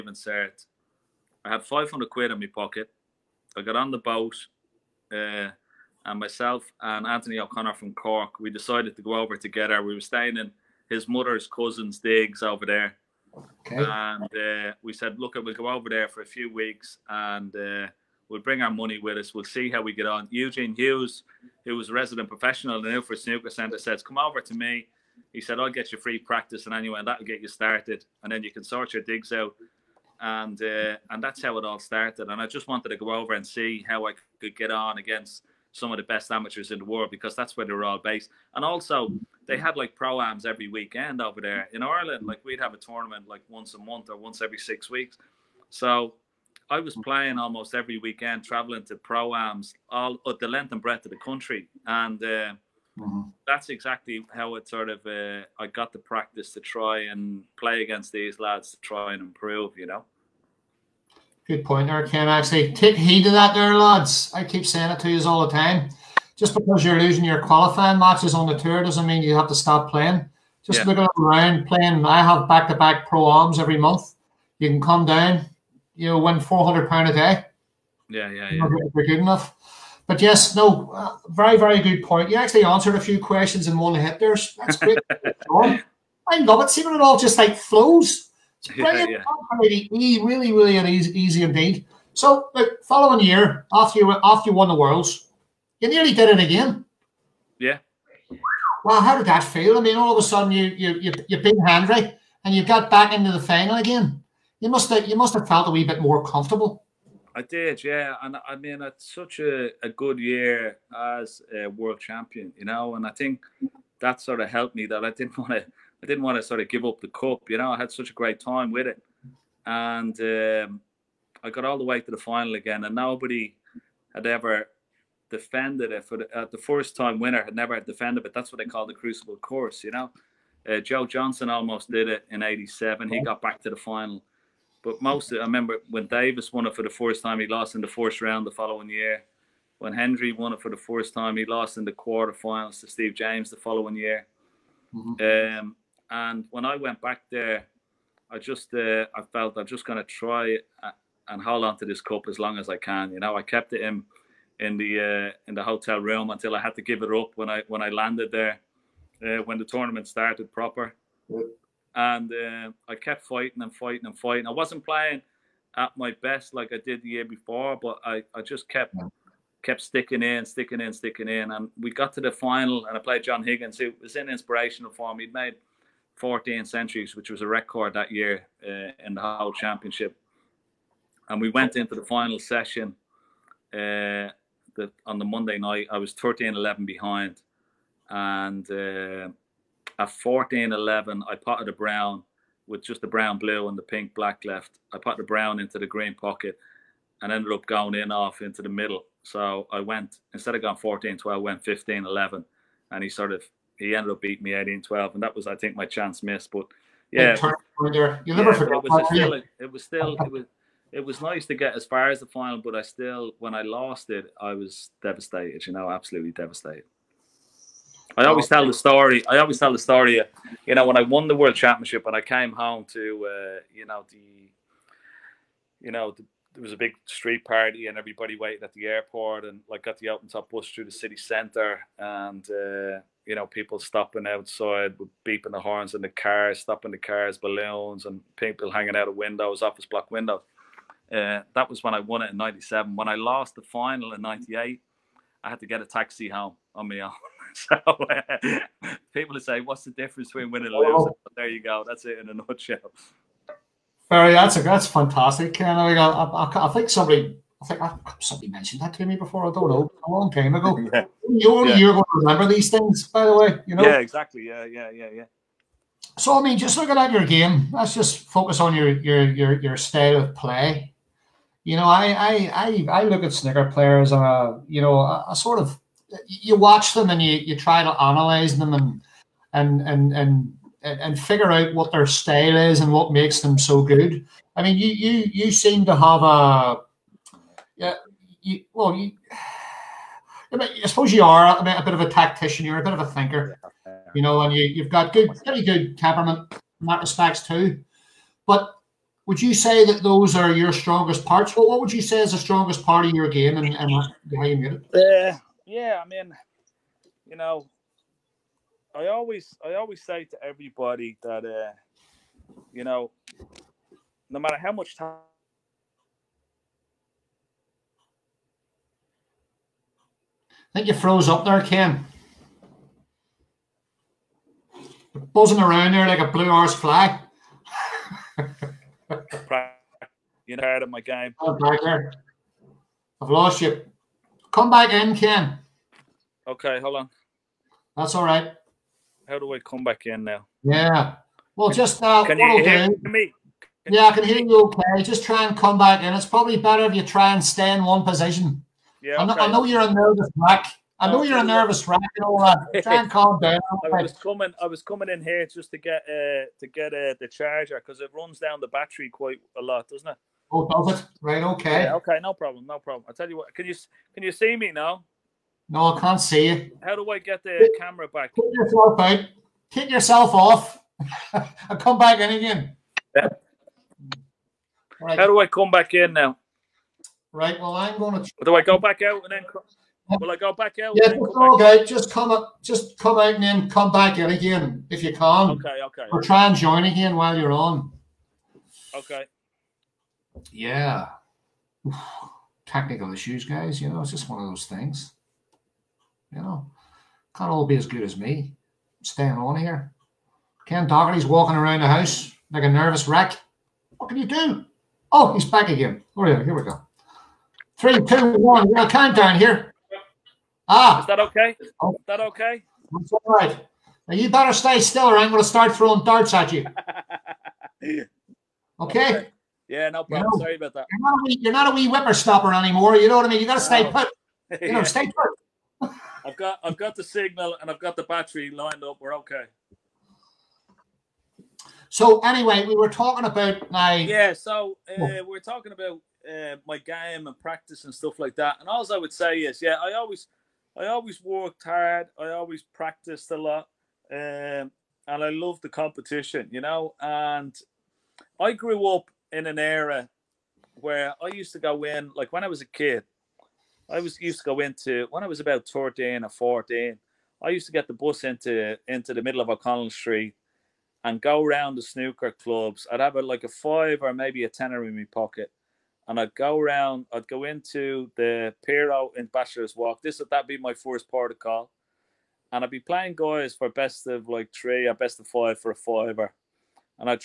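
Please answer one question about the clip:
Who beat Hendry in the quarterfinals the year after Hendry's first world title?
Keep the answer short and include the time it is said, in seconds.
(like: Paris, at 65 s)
Steve James, at 142 s.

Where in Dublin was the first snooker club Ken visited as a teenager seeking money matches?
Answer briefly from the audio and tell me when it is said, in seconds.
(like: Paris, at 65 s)
Bachelor's Walk, at 469 s.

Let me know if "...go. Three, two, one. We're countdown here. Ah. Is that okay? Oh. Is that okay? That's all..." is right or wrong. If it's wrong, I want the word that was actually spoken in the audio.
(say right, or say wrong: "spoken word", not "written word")
right.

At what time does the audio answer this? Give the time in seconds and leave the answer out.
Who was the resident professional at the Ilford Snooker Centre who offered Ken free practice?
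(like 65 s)
20 s.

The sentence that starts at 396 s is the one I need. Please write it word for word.
You know, can't all be as good as me.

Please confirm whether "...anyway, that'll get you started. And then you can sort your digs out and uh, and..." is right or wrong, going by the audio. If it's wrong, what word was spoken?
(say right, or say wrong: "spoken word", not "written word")
right.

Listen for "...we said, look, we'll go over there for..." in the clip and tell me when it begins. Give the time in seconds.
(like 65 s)
14 s.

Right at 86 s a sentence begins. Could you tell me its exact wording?
Seeing it all just like flows.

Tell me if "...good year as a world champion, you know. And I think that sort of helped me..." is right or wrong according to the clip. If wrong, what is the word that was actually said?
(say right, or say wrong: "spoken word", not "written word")
right.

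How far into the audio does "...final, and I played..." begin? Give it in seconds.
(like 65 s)
172 s.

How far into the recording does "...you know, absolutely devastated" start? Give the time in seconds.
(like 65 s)
215 s.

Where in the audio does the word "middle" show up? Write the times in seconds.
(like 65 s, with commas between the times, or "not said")
198 s, 459 s.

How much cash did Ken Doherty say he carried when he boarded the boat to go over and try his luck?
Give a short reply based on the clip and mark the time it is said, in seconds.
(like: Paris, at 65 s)
£500, at 1 s.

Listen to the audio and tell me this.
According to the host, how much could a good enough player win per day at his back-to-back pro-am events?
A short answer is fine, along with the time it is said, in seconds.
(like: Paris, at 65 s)
£400, at 76 s.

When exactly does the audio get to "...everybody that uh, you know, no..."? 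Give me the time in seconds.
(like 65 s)
310 s.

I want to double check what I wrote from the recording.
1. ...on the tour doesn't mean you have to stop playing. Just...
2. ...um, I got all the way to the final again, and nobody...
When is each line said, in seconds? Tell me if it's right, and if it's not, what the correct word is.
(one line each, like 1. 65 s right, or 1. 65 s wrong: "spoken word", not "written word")
1. 68 s right
2. 120 s right.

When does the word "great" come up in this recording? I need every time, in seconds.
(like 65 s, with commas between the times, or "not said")
84 s, 118 s.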